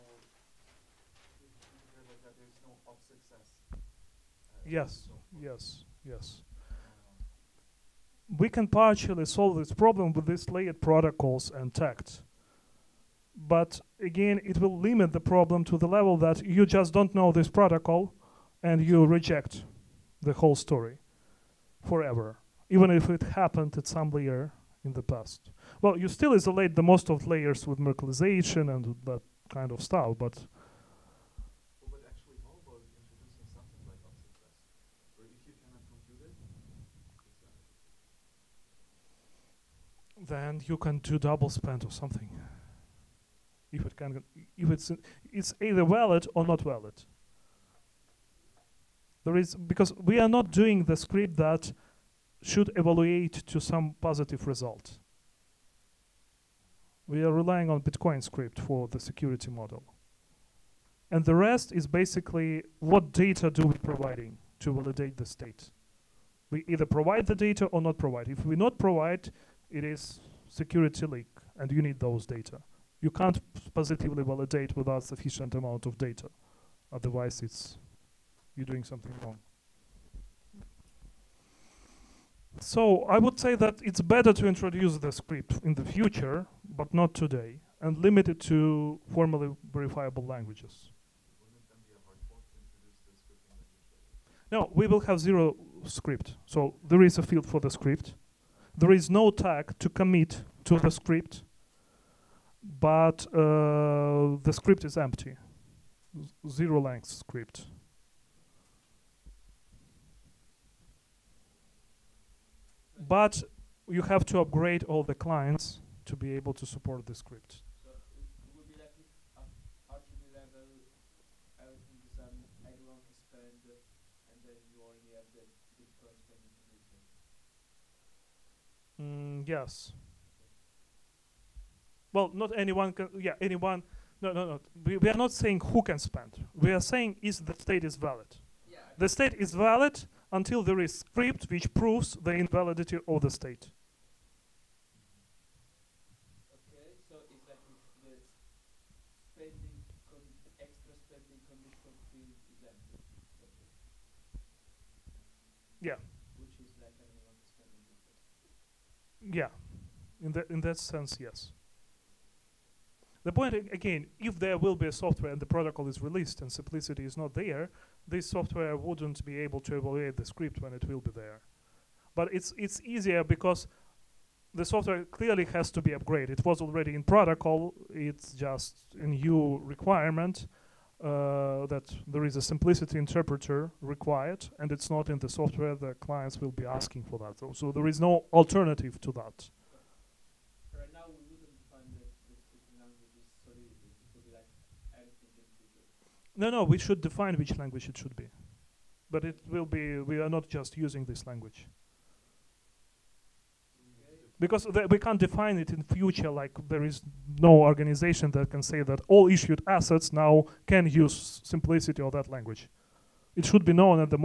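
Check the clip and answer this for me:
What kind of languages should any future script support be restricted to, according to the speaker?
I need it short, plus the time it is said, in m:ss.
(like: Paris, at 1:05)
formally verifiable languages, at 1:29.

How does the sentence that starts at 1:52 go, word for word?
But you have to upgrade all the clients to be able to support the script.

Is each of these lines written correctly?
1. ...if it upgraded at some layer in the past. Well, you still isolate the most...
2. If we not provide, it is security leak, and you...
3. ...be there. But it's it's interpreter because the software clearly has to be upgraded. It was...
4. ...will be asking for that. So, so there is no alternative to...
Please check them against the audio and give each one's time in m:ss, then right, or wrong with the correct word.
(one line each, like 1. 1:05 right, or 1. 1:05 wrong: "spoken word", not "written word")
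1. 0:22 wrong: "happened", not "upgraded"
2. 1:08 right
3. 2:50 wrong: "easier", not "interpreter"
4. 3:06 right.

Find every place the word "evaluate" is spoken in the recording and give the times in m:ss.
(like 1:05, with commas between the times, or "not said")
0:52, 2:49.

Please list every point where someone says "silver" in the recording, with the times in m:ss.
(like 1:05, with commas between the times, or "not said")
not said.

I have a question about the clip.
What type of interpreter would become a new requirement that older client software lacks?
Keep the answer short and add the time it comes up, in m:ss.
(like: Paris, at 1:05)
simplicity interpreter, at 3:02.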